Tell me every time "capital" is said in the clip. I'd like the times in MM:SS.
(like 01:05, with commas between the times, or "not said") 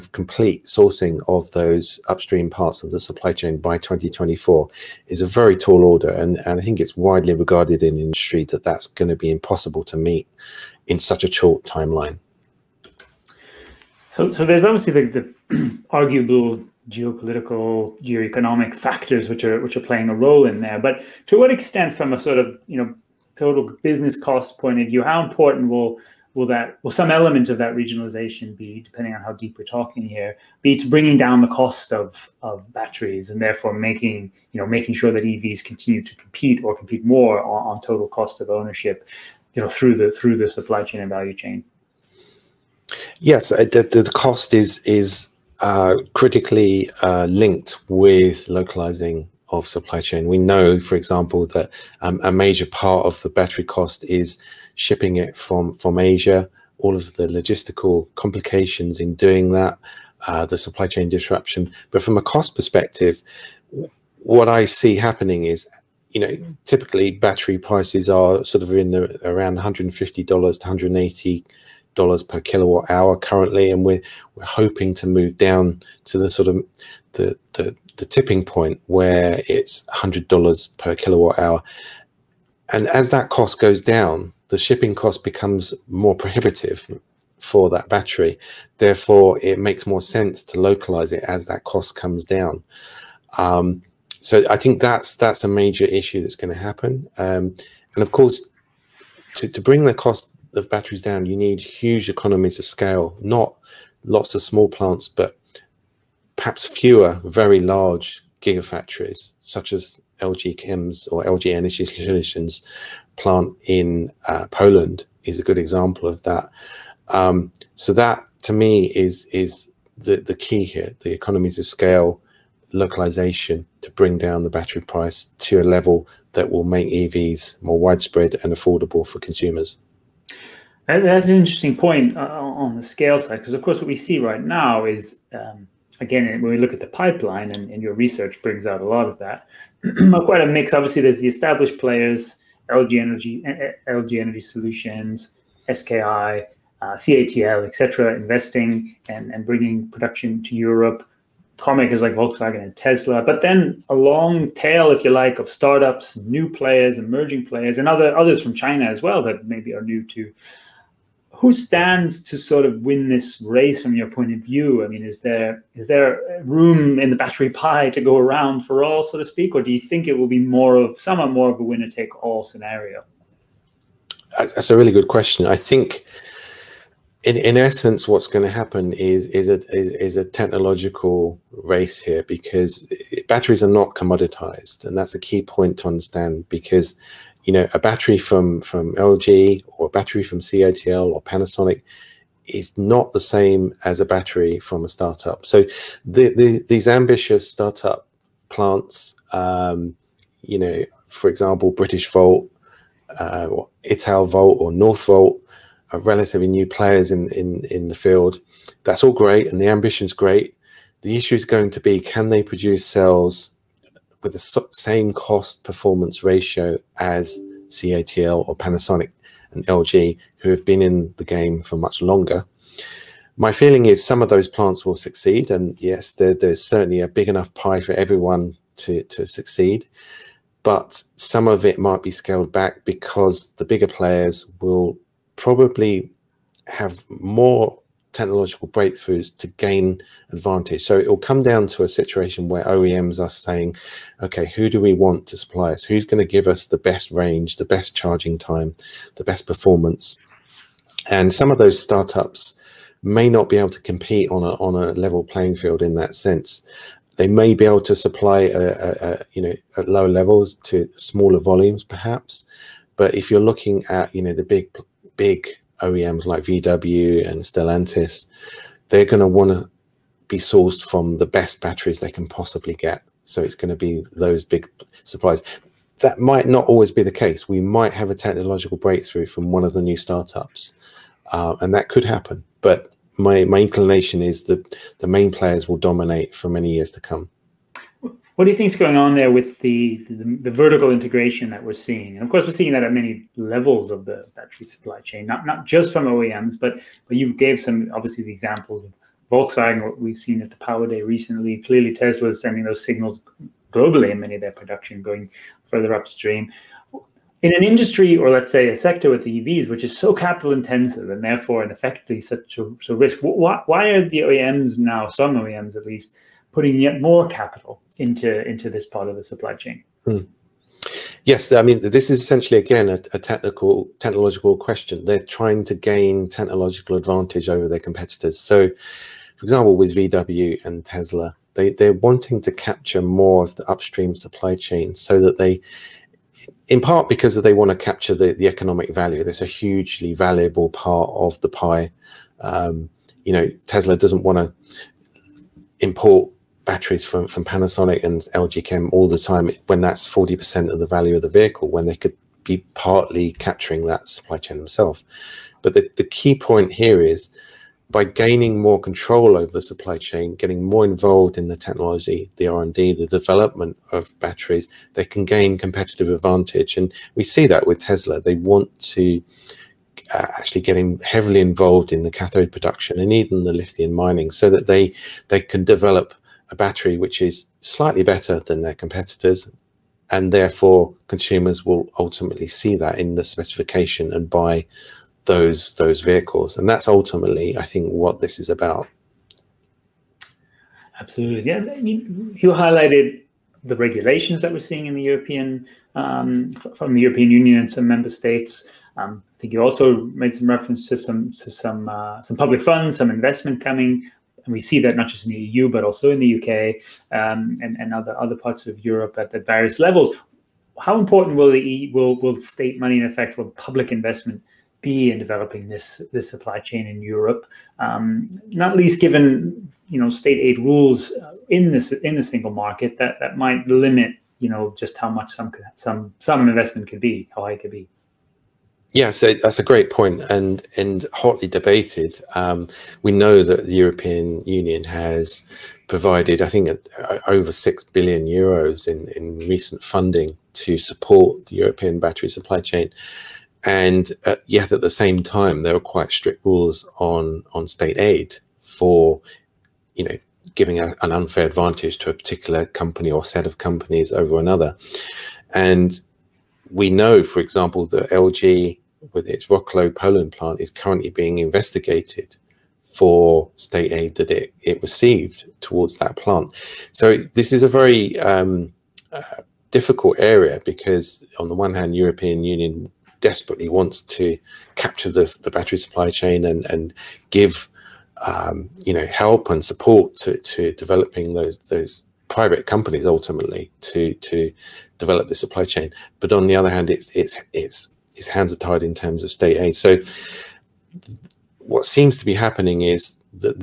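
05:10, 05:17.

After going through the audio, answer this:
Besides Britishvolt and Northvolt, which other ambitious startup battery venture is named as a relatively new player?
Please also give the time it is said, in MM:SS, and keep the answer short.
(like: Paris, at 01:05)
Italvolt, at 03:23.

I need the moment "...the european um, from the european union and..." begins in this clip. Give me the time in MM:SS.
06:34.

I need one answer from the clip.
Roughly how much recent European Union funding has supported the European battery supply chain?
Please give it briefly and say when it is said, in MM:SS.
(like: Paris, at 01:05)
Over 6 billion euros, at 07:17.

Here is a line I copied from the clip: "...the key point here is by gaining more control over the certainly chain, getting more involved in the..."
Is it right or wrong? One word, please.
wrong.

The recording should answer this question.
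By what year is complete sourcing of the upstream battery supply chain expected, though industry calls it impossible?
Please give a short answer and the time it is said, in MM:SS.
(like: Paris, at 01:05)
2024, at 00:03.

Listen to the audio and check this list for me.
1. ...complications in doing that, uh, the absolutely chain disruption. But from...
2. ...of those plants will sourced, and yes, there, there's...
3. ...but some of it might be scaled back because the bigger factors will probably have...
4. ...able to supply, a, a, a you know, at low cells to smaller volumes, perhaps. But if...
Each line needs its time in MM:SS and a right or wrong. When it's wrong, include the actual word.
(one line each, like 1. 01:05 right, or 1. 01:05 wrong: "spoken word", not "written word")
1. 00:58 wrong: "supply", not "absolutely"
2. 03:44 wrong: "succeed", not "sourced"
3. 03:50 wrong: "players", not "factors"
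4. 04:17 wrong: "levels", not "cells".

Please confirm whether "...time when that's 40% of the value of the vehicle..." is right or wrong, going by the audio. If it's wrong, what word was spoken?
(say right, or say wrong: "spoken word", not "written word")
right.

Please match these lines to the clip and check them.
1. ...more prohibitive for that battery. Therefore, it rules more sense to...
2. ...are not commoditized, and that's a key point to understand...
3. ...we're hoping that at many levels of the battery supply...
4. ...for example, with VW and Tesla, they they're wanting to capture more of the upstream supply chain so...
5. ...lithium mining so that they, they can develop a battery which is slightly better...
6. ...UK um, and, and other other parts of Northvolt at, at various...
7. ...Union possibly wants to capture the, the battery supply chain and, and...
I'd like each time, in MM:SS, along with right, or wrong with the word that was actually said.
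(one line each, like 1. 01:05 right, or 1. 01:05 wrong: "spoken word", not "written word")
1. 01:25 wrong: "makes", not "rules"
2. 03:03 right
3. 04:52 wrong: "seeing", not "hoping"
4. 05:28 right
5. 06:13 right
6. 06:46 wrong: "Europe", not "Northvolt"
7. 07:52 wrong: "desperately", not "possibly".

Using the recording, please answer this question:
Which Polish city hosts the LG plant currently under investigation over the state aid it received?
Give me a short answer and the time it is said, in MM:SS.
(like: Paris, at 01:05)
Wroclaw, at 07:39.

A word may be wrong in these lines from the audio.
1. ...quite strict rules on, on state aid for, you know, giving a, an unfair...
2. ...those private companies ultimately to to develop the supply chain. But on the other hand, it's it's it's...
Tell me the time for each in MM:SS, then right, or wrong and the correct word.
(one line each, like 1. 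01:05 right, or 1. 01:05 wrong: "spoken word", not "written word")
1. 07:25 right
2. 08:01 right.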